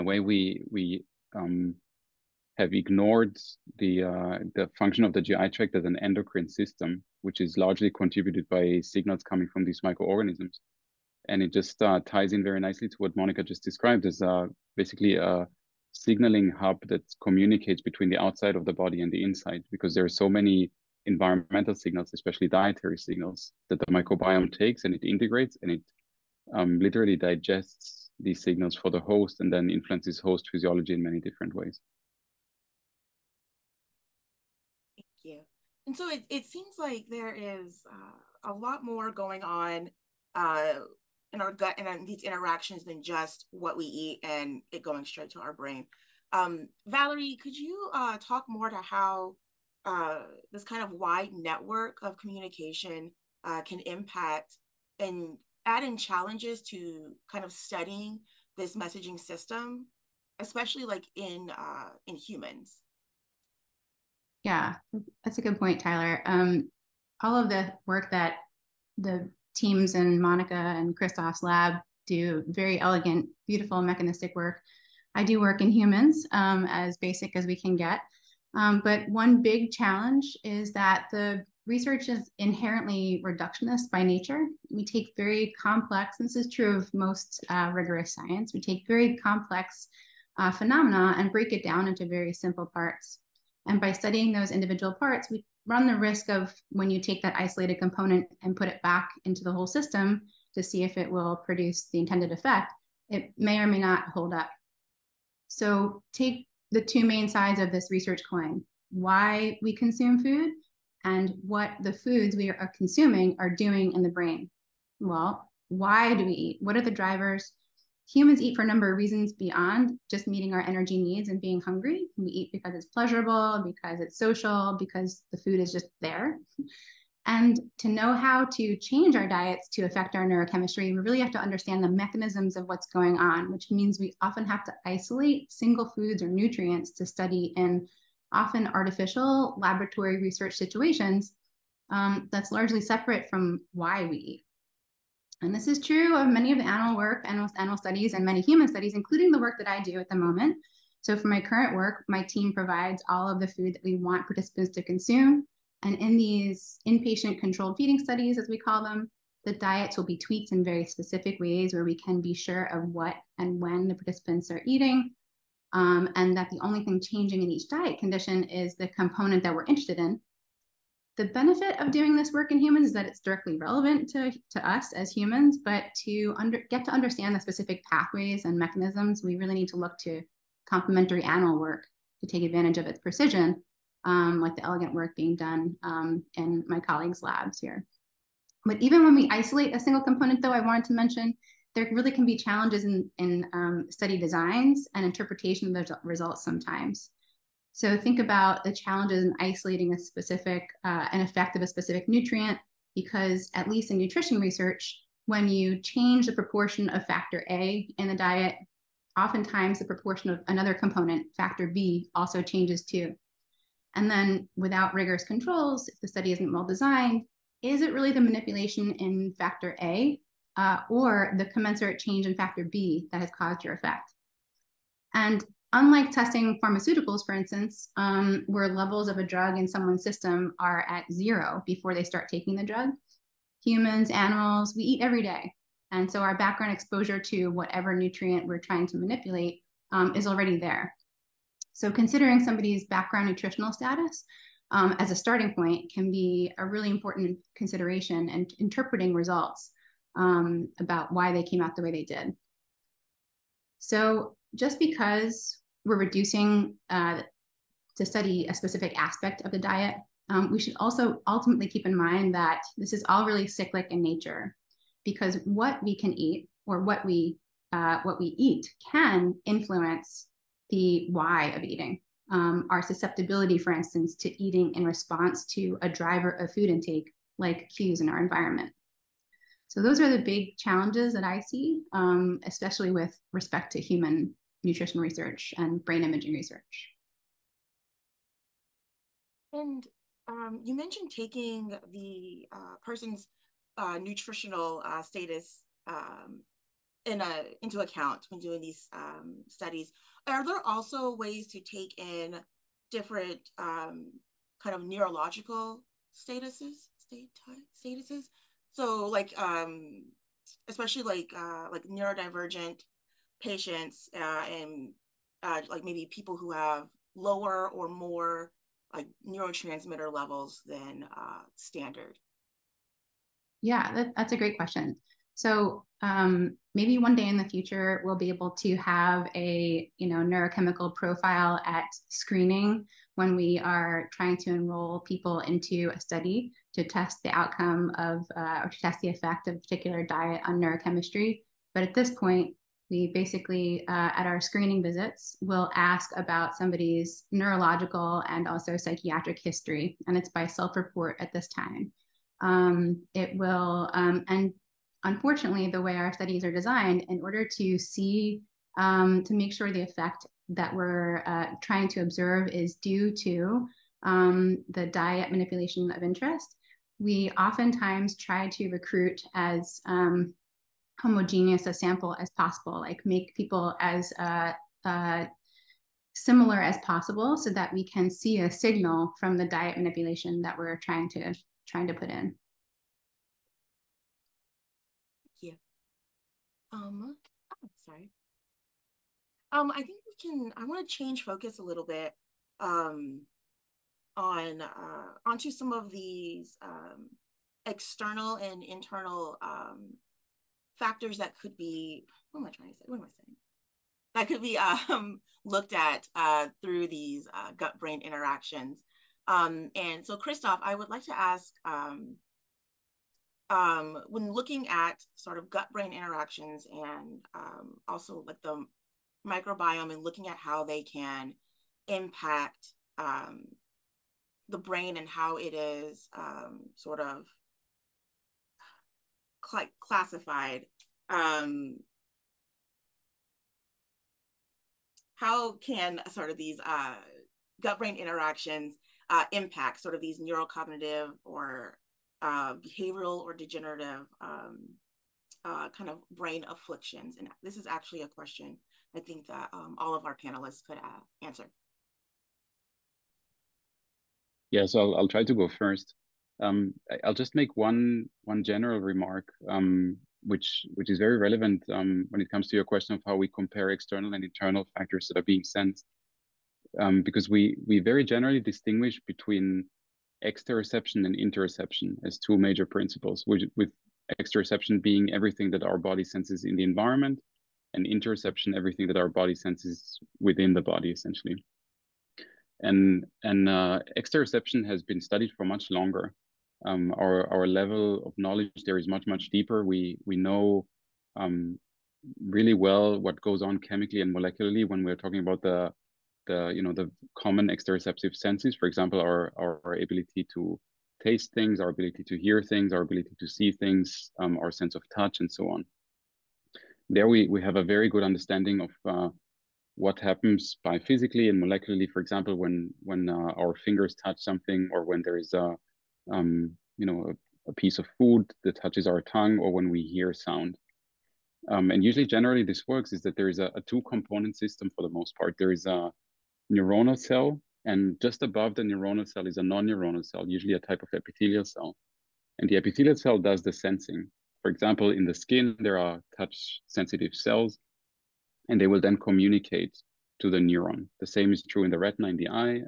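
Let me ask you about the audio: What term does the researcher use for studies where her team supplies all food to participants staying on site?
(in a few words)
inpatient controlled feeding studies.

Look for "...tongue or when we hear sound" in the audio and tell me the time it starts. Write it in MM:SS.
08:39.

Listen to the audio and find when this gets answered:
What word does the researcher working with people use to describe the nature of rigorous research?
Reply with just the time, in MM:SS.
01:23.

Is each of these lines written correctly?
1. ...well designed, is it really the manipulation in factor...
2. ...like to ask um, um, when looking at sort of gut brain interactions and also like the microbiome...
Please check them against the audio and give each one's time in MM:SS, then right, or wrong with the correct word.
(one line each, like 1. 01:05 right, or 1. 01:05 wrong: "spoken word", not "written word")
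1. 03:36 right
2. 06:50 right.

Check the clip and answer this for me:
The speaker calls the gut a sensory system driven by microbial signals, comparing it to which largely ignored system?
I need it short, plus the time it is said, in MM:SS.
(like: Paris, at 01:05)
endocrine system, at 00:05.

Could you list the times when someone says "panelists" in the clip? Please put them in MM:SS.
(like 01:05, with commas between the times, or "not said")
07:30.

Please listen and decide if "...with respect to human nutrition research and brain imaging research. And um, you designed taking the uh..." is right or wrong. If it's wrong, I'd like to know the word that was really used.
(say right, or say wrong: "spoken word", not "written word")
wrong: "mentioned", not "designed".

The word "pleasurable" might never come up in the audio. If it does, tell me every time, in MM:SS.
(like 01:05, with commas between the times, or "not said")
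02:02.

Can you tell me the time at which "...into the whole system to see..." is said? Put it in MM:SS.
01:39.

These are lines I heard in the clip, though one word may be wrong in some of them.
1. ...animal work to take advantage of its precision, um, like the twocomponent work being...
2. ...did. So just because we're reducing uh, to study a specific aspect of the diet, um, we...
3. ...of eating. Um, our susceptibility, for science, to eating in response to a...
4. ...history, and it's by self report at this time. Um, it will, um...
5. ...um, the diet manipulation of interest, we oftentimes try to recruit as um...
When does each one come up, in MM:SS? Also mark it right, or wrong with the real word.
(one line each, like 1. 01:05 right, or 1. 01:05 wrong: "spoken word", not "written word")
1. 03:01 wrong: "elegant", not "twocomponent"
2. 04:12 right
3. 04:31 wrong: "instance", not "science"
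4. 05:49 right
5. 06:04 right.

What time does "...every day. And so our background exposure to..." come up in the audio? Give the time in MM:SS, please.
03:55.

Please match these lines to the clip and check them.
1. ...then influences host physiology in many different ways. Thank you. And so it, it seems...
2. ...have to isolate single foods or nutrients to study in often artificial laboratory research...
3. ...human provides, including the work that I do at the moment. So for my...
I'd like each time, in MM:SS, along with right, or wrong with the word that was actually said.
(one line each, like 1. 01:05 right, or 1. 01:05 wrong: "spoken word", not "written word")
1. 00:29 right
2. 02:14 right
3. 02:28 wrong: "studies", not "provides".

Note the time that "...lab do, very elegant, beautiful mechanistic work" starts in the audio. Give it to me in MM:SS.
01:11.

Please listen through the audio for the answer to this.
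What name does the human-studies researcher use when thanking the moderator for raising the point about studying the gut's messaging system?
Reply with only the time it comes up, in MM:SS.
01:05.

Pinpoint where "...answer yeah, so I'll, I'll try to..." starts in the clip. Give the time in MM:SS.
07:31.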